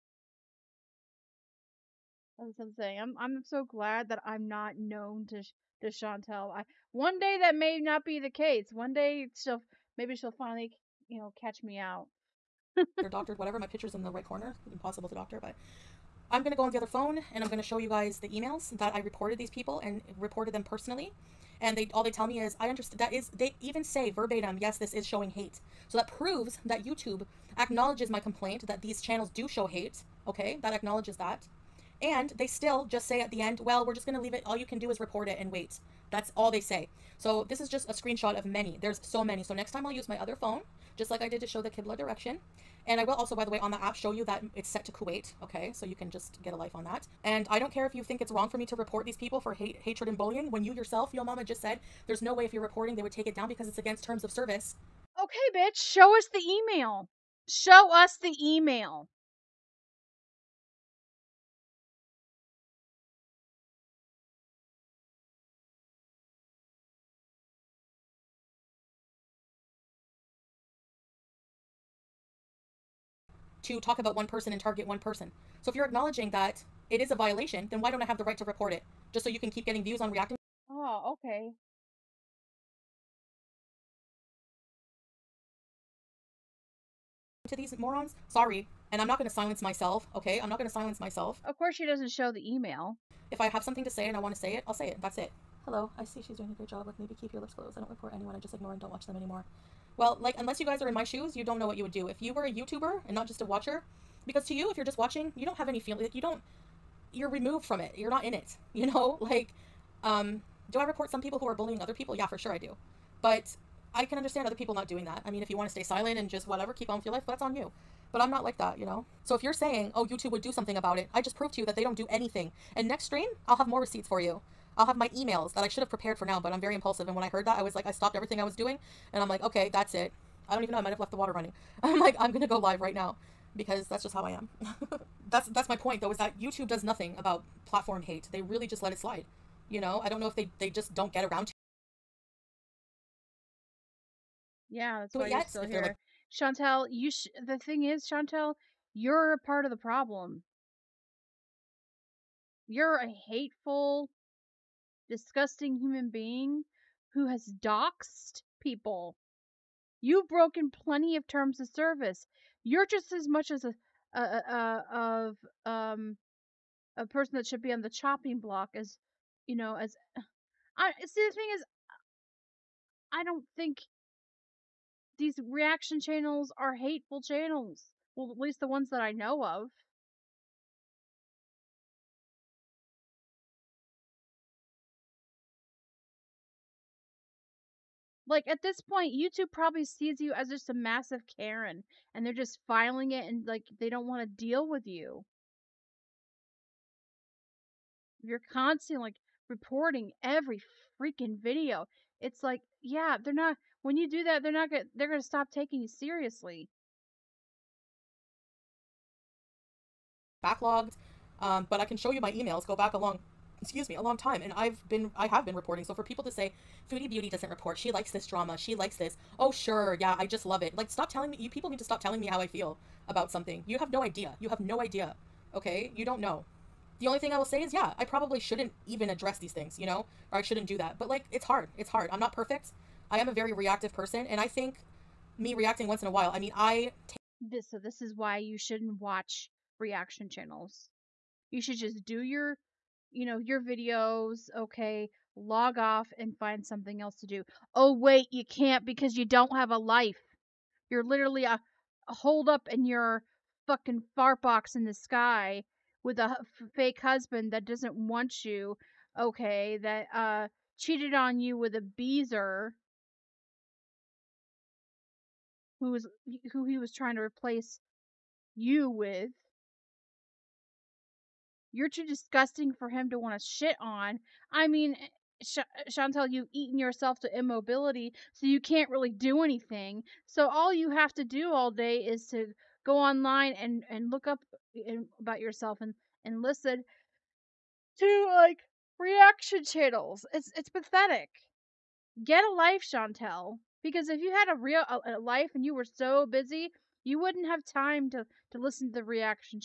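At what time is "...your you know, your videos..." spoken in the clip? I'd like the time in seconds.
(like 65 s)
242 s.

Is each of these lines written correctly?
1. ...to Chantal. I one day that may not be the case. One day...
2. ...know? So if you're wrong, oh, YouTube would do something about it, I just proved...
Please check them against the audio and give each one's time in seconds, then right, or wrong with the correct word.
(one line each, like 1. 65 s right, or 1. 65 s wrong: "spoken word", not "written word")
1. 5 s right
2. 118 s wrong: "saying", not "wrong".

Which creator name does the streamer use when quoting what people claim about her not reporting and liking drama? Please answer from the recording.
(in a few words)
Foodie Beauty.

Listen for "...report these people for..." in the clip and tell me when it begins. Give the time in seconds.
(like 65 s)
48 s.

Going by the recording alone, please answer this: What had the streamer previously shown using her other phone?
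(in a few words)
The Kibla direction.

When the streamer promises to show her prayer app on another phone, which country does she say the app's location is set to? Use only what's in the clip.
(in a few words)
Kuwait.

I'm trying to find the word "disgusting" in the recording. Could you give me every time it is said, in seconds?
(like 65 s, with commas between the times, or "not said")
155 s, 272 s.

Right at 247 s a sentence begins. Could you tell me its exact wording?
Oh, wait, you can't because you don't have a life.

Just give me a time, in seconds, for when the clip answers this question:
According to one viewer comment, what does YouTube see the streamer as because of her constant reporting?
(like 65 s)
191 s.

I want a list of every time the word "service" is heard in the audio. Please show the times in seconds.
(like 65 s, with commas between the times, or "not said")
54 s, 161 s.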